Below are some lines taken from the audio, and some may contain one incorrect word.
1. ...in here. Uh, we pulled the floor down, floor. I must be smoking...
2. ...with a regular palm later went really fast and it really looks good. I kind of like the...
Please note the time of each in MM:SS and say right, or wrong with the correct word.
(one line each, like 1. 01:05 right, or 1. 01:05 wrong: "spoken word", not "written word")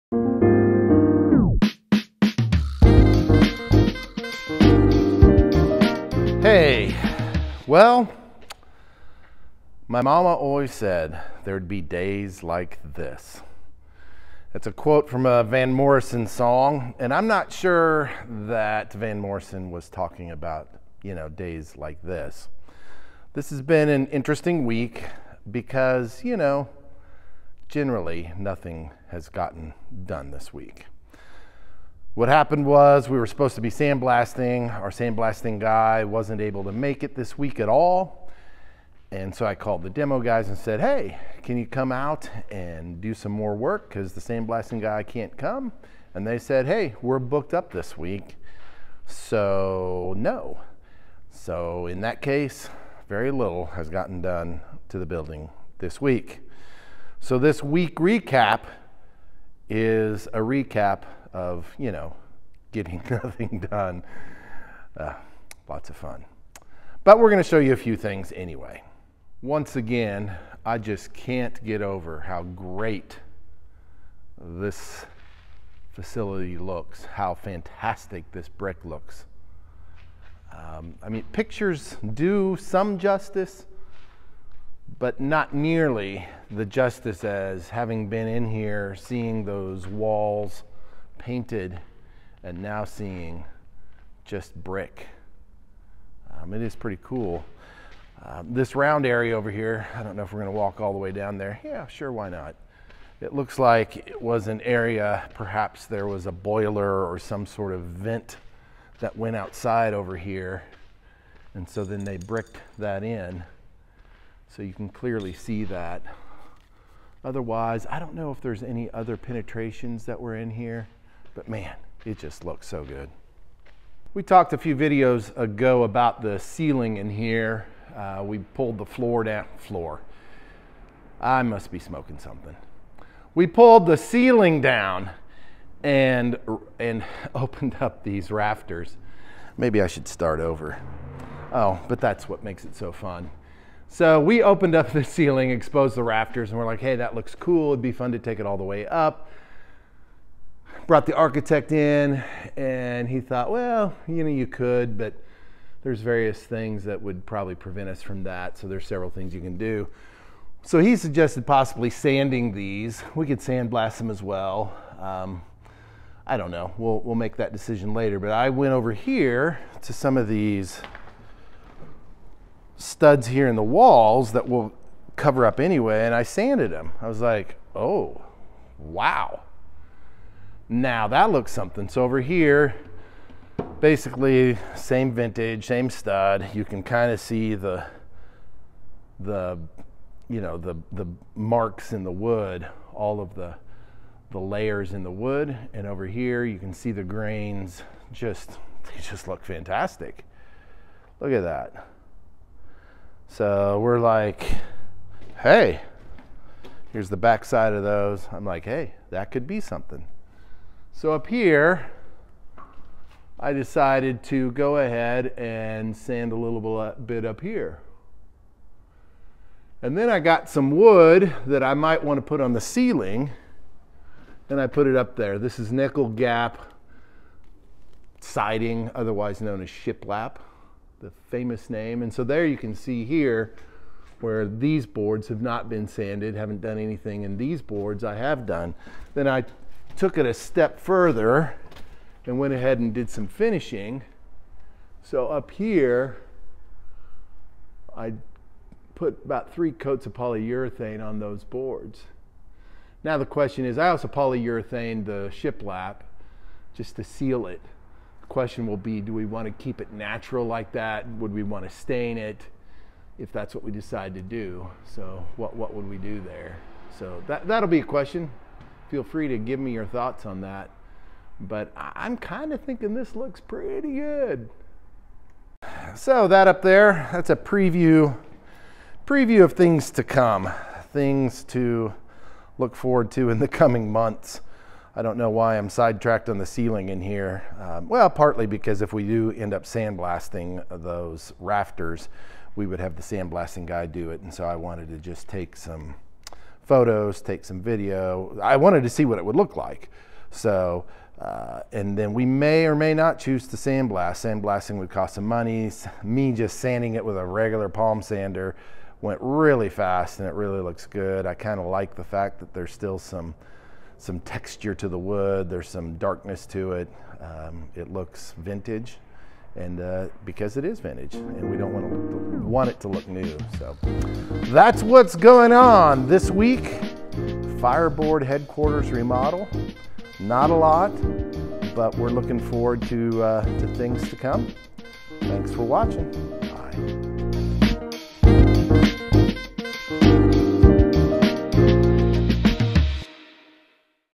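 1. 02:06 right
2. 05:07 wrong: "sander", not "later".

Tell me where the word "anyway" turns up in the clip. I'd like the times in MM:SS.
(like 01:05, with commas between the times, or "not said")
01:08, 02:55.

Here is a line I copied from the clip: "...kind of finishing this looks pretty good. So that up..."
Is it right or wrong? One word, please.
wrong.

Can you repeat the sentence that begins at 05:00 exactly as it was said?
So, uh, and then we may or may not choose to sandblast.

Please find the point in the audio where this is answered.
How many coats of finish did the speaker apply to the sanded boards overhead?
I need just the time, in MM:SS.
04:09.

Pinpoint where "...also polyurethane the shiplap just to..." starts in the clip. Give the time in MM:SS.
04:13.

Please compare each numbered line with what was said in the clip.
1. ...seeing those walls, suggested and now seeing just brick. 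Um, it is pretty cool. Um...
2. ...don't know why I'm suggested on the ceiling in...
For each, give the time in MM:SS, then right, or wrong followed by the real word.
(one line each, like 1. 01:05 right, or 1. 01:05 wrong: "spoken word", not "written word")
1. 01:28 wrong: "painted", not "suggested"
2. 04:45 wrong: "sidetracked", not "suggested".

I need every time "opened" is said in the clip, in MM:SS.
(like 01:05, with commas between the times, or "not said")
02:17, 02:24.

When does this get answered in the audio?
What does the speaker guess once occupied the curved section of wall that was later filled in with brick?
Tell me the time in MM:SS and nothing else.
01:46.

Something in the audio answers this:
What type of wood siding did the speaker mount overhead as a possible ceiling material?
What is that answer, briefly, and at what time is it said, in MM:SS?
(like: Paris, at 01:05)
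Nickel gap siding, at 03:45.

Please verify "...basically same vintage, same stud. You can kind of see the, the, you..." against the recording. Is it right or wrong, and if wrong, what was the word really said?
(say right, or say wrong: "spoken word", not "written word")
right.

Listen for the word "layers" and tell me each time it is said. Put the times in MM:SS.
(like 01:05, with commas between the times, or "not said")
03:14.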